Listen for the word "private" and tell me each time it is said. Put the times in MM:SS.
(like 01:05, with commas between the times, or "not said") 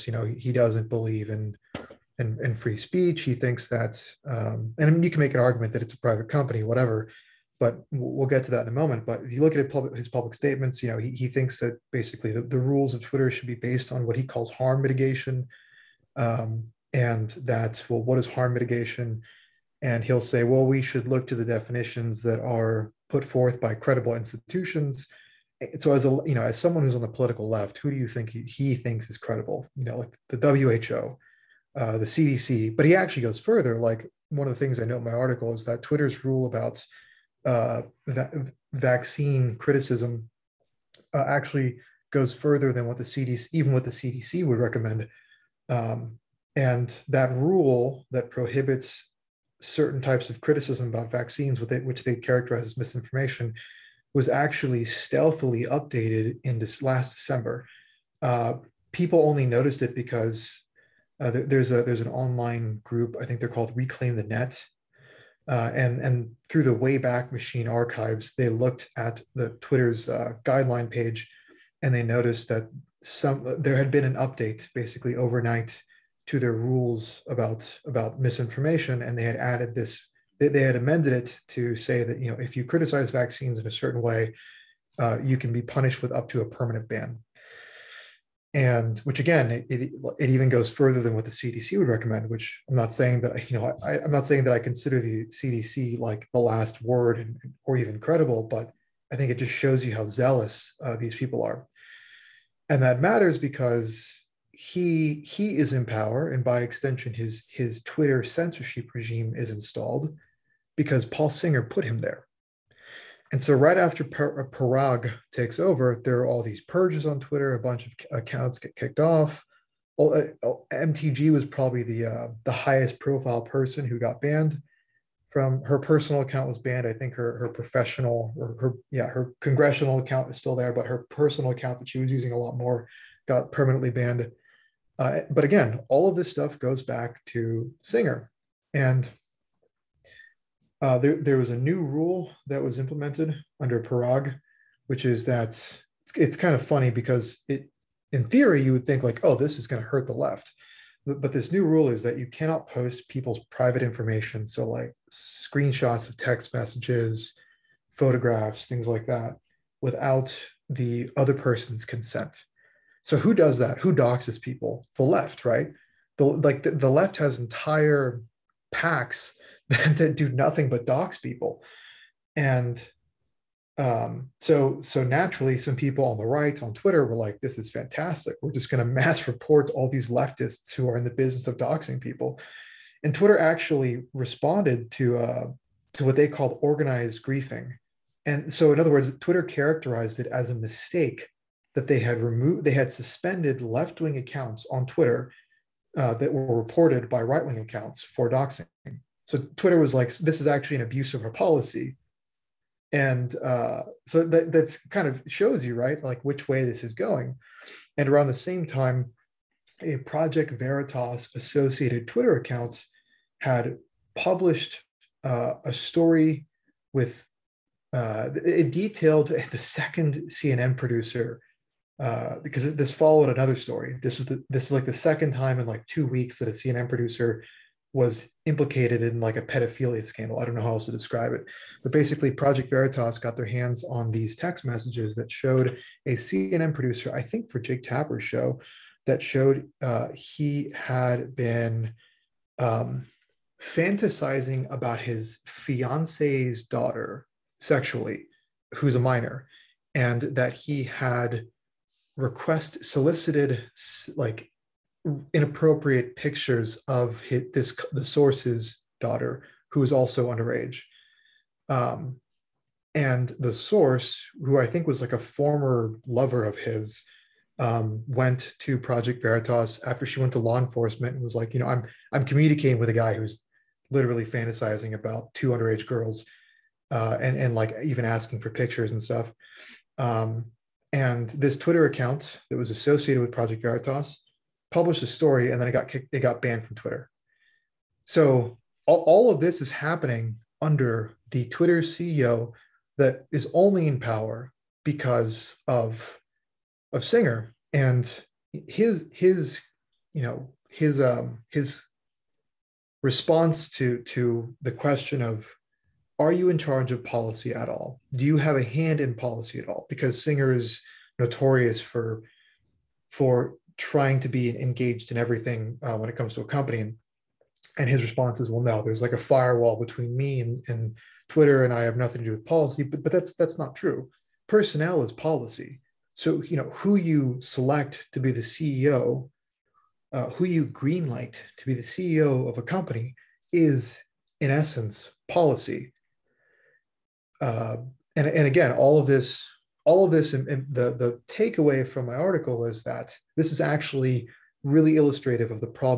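00:06, 02:33.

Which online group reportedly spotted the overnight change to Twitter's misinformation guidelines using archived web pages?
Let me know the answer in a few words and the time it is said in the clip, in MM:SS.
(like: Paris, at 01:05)
Reclaim the Net, at 01:03.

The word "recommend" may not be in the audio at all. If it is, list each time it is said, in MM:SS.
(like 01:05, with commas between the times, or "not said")
00:44, 01:31.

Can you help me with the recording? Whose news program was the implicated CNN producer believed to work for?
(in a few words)
Jake Tapper.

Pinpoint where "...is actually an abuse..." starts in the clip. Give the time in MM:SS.
03:20.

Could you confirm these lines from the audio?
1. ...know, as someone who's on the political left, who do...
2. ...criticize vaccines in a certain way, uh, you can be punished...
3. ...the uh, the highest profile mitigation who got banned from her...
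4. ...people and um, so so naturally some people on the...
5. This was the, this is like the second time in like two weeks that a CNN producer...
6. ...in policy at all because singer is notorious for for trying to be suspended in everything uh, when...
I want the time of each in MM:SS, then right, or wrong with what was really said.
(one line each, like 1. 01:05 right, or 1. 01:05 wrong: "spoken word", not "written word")
1. 00:26 right
2. 01:22 right
3. 02:01 wrong: "person", not "mitigation"
4. 02:51 right
5. 03:44 right
6. 05:09 wrong: "engaged", not "suspended".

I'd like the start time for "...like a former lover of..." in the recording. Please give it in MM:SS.
04:25.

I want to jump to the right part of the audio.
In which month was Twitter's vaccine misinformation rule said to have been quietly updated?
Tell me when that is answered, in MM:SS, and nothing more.
00:57.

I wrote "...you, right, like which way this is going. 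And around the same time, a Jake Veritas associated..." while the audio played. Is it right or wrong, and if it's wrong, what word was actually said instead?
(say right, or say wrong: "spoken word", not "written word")
wrong: "Project", not "Jake".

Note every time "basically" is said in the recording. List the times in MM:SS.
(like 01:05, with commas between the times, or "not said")
00:11, 01:14, 03:51.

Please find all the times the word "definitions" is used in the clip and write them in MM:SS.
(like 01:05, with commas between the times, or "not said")
00:21.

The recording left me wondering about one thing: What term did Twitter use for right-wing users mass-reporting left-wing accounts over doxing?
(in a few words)
organized griefing.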